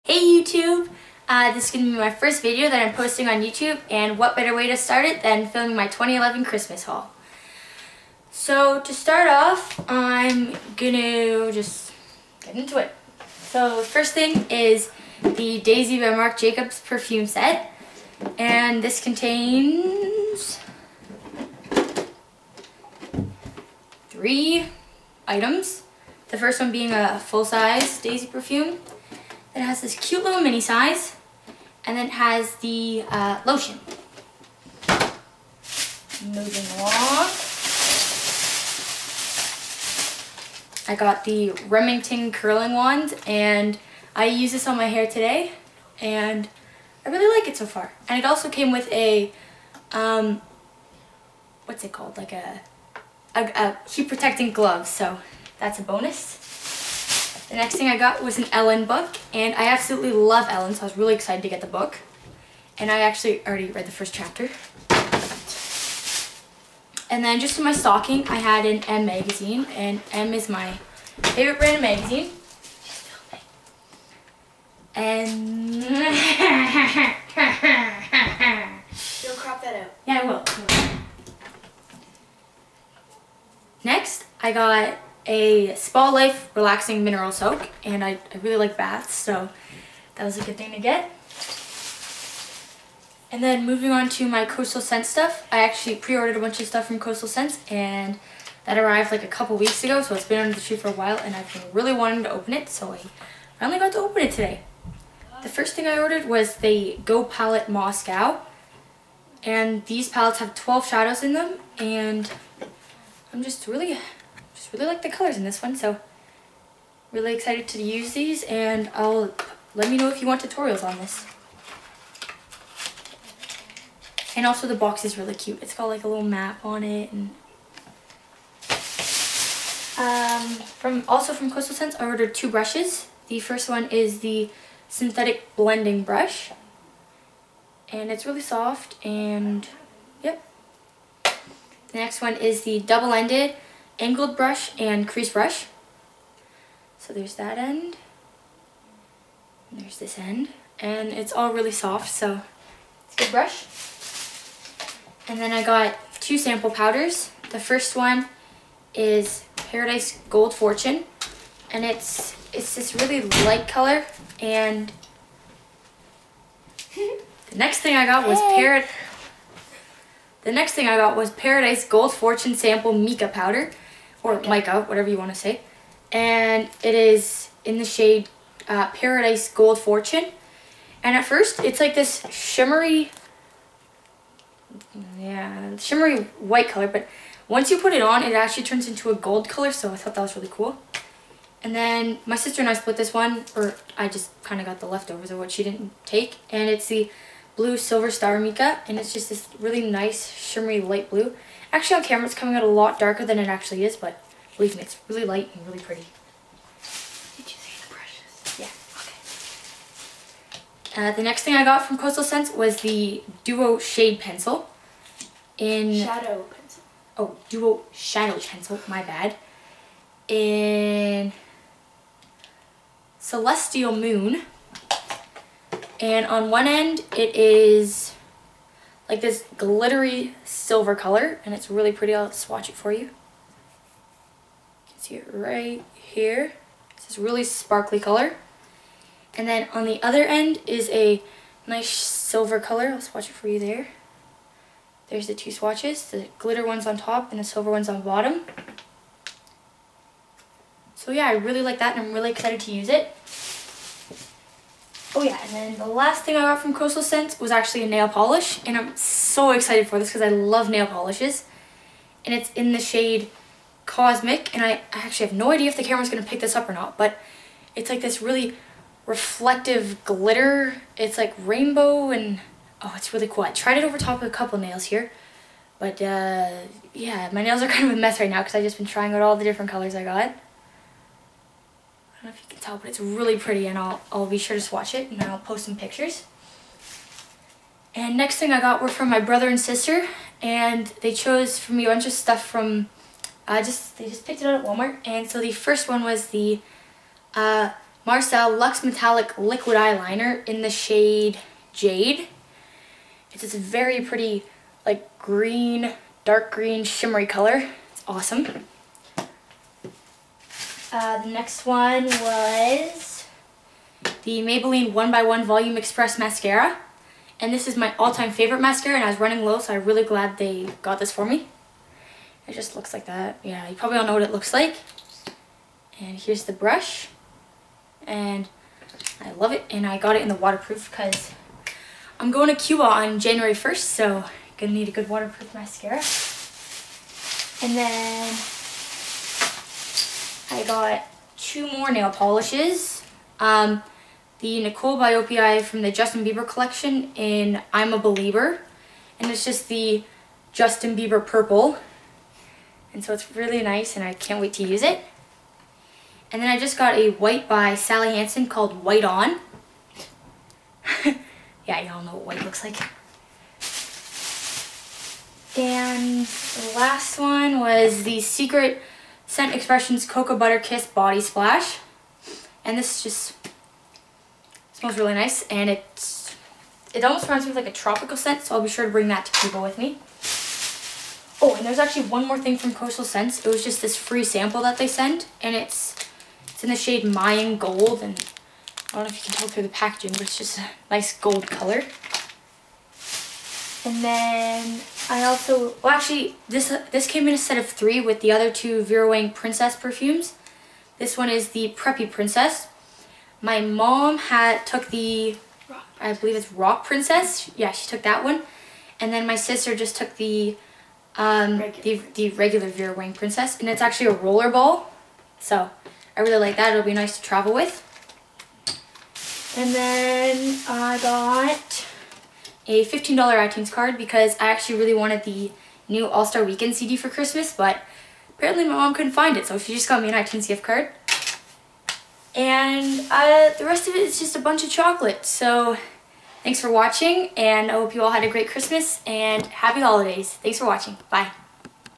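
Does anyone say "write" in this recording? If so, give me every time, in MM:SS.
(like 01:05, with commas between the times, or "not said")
not said.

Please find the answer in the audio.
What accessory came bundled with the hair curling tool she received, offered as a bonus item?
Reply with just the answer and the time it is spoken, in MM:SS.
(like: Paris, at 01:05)
Heat protecting glove, at 00:53.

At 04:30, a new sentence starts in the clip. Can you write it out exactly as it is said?
It's like rainbow, and oh, it's really cool.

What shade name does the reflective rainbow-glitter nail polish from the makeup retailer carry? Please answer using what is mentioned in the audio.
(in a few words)
Cosmic.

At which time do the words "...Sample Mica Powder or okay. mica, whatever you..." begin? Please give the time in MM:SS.
02:52.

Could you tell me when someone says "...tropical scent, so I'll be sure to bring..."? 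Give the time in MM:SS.
06:17.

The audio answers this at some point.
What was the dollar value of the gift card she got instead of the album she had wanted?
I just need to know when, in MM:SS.
07:02.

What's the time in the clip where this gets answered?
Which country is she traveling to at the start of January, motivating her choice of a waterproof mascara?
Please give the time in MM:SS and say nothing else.
05:32.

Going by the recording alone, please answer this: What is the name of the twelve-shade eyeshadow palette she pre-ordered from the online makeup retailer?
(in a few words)
Go Palette Moscow.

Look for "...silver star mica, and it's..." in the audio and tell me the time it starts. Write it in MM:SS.
03:17.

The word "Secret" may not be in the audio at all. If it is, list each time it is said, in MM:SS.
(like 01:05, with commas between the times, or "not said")
06:08.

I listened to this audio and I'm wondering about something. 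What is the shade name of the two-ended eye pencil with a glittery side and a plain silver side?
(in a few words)
Celestial Moon.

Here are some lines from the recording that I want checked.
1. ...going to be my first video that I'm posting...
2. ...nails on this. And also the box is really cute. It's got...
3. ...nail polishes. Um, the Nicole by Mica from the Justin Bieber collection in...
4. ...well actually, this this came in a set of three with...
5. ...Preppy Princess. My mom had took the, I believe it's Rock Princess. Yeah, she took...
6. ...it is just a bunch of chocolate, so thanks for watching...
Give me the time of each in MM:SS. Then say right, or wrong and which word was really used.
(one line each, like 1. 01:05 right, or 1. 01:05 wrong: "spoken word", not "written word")
1. 00:01 right
2. 02:00 wrong: "tutorials", not "nails"
3. 05:41 wrong: "OPI", not "Mica"
4. 06:35 right
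5. 06:41 right
6. 07:13 right.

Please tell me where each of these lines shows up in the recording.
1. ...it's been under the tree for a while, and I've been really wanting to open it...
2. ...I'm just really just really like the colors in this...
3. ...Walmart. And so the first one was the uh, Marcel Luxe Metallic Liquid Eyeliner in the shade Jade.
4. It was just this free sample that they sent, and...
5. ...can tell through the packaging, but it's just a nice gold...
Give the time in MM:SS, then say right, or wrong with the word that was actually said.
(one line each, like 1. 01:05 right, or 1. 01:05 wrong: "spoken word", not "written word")
1. 01:40 right
2. 01:53 right
3. 04:54 right
4. 06:23 right
5. 06:29 right.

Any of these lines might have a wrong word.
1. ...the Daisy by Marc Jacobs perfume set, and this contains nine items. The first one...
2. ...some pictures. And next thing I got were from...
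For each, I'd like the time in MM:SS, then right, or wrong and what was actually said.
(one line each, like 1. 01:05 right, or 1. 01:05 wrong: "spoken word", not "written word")
1. 00:15 wrong: "three", not "nine"
2. 04:45 right.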